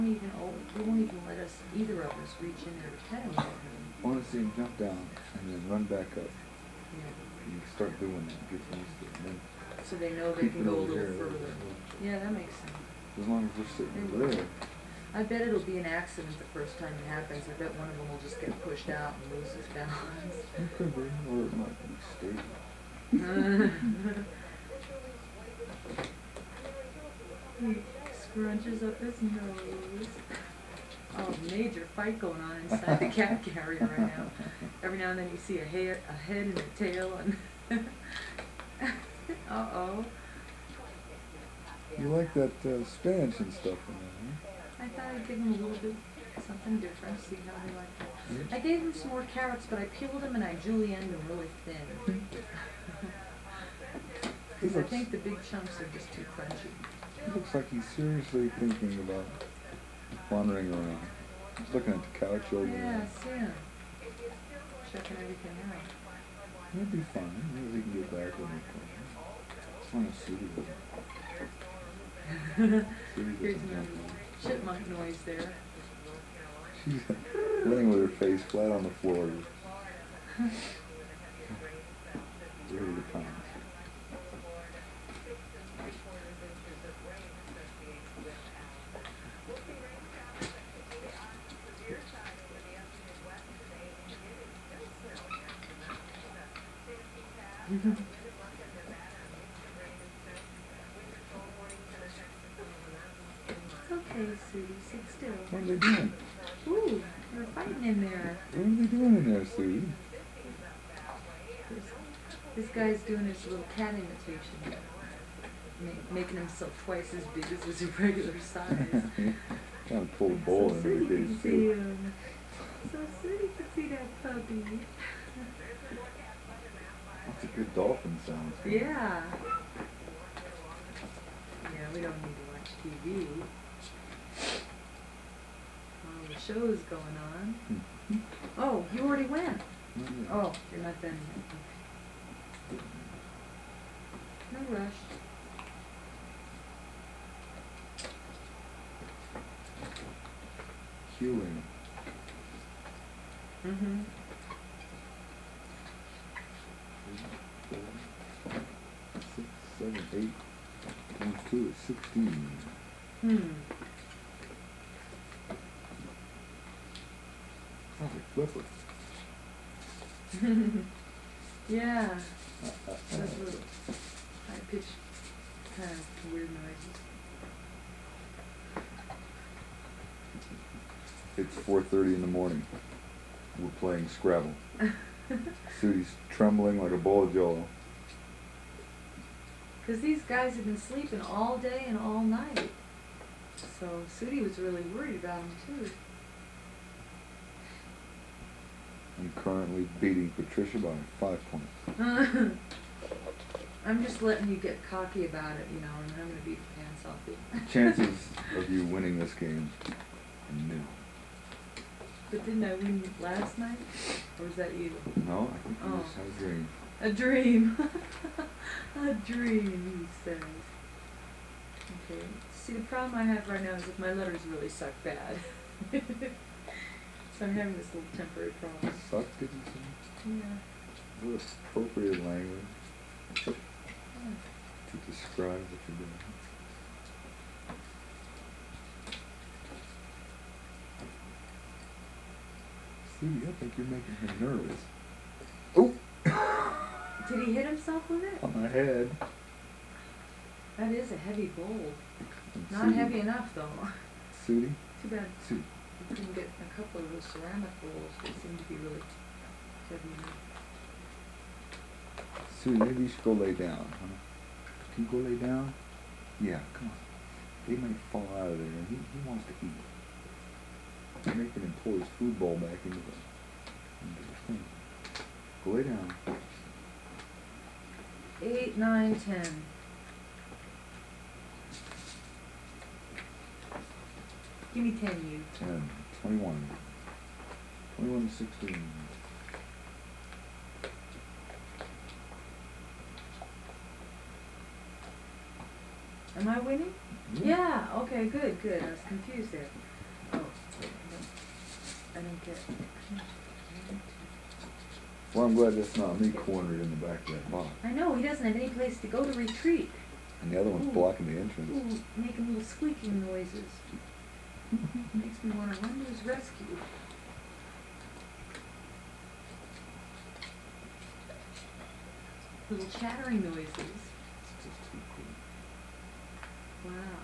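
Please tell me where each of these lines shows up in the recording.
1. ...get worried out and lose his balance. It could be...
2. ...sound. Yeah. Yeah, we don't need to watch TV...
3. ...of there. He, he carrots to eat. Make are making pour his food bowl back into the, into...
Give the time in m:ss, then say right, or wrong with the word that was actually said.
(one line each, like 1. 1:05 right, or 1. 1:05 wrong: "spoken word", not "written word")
1. 0:18 wrong: "pushed", not "worried"
2. 2:08 right
3. 4:28 wrong: "wants", not "carrots".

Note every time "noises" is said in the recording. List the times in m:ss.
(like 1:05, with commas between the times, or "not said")
1:14, 5:13, 5:23.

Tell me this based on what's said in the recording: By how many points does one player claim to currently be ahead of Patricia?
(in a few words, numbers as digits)
5.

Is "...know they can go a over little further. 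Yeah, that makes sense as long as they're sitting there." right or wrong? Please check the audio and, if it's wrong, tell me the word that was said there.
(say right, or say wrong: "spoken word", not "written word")
right.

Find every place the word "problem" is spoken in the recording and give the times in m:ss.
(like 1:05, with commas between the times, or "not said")
3:42, 3:48.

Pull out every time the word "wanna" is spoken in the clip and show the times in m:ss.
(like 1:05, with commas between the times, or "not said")
0:04.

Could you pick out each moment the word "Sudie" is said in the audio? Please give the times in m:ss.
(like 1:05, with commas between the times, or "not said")
3:05, 3:14.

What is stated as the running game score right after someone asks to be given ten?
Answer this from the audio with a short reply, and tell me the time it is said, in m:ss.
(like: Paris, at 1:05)
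21 to 16, at 4:47.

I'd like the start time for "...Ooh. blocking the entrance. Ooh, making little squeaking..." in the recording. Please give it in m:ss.
5:10.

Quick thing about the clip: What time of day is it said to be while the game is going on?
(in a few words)
4:30 in the morning.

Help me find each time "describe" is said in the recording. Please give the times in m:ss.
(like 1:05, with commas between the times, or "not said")
3:55.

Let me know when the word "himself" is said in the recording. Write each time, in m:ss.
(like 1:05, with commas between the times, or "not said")
1:56, 4:07.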